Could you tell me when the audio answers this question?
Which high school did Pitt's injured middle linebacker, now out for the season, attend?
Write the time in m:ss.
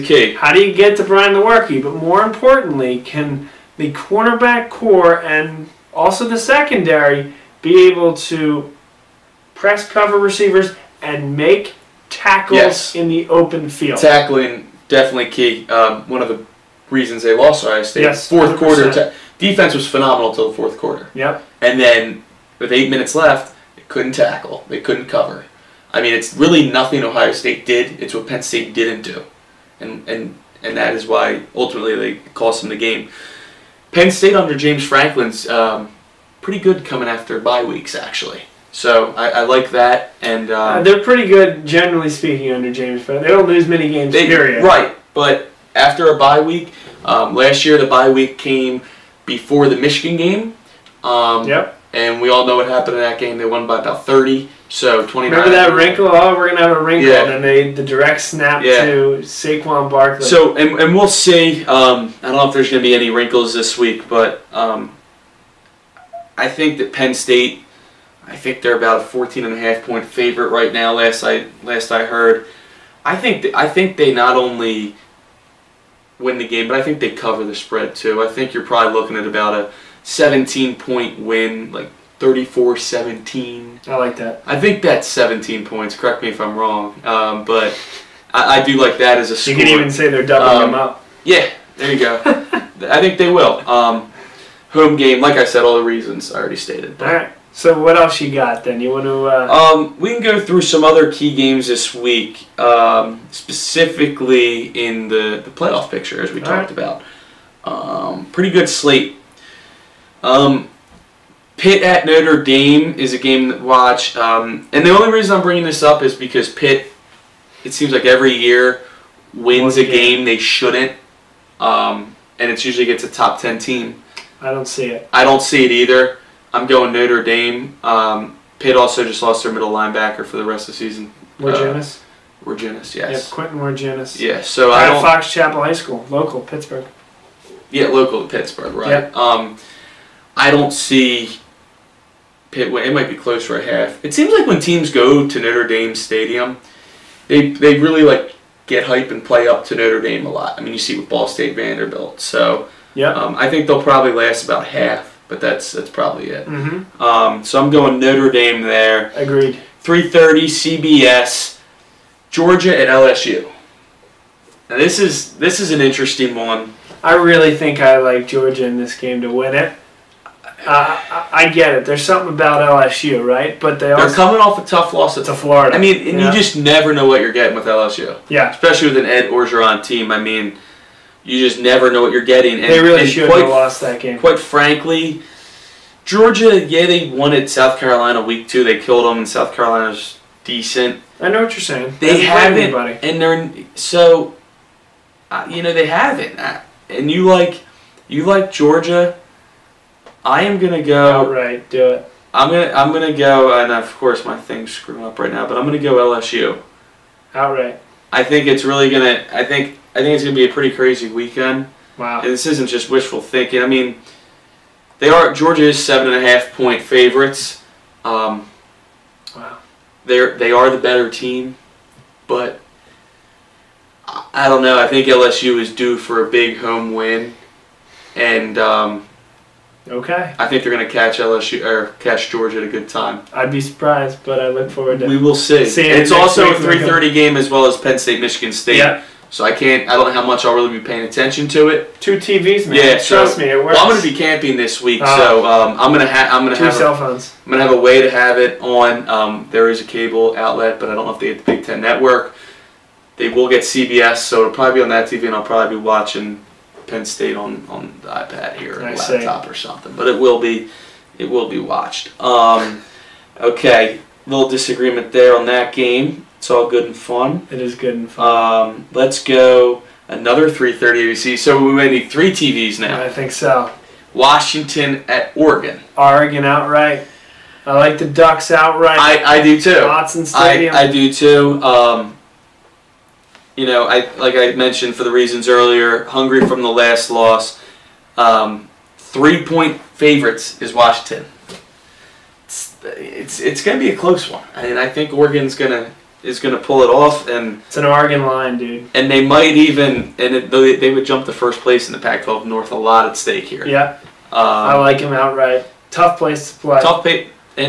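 2:15.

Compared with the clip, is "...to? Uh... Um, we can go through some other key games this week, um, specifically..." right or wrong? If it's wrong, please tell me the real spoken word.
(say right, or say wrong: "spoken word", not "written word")
right.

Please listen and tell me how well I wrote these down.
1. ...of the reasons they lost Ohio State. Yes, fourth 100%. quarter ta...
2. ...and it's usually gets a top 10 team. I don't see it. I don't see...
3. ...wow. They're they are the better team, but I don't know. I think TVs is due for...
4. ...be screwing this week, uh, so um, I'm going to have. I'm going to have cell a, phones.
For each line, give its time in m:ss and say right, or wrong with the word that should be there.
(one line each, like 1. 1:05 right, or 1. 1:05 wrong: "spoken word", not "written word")
1. 0:16 right
2. 2:02 right
3. 3:39 wrong: "LSU", not "TVs"
4. 4:04 wrong: "camping", not "screwing".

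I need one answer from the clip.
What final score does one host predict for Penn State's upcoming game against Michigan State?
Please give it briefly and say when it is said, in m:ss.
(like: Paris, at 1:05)
34-17, at 1:22.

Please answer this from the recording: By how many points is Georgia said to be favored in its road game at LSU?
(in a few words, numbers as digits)
7.5.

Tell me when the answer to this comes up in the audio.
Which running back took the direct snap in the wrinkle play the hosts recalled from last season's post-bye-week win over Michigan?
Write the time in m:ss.
0:59.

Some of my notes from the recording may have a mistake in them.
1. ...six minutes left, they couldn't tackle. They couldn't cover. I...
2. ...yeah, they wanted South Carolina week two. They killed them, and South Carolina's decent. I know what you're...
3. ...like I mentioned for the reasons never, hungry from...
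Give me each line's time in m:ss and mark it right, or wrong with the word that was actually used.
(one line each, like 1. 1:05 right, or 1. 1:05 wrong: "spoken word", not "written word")
1. 0:22 wrong: "eight", not "six"
2. 3:06 right
3. 4:44 wrong: "earlier", not "never".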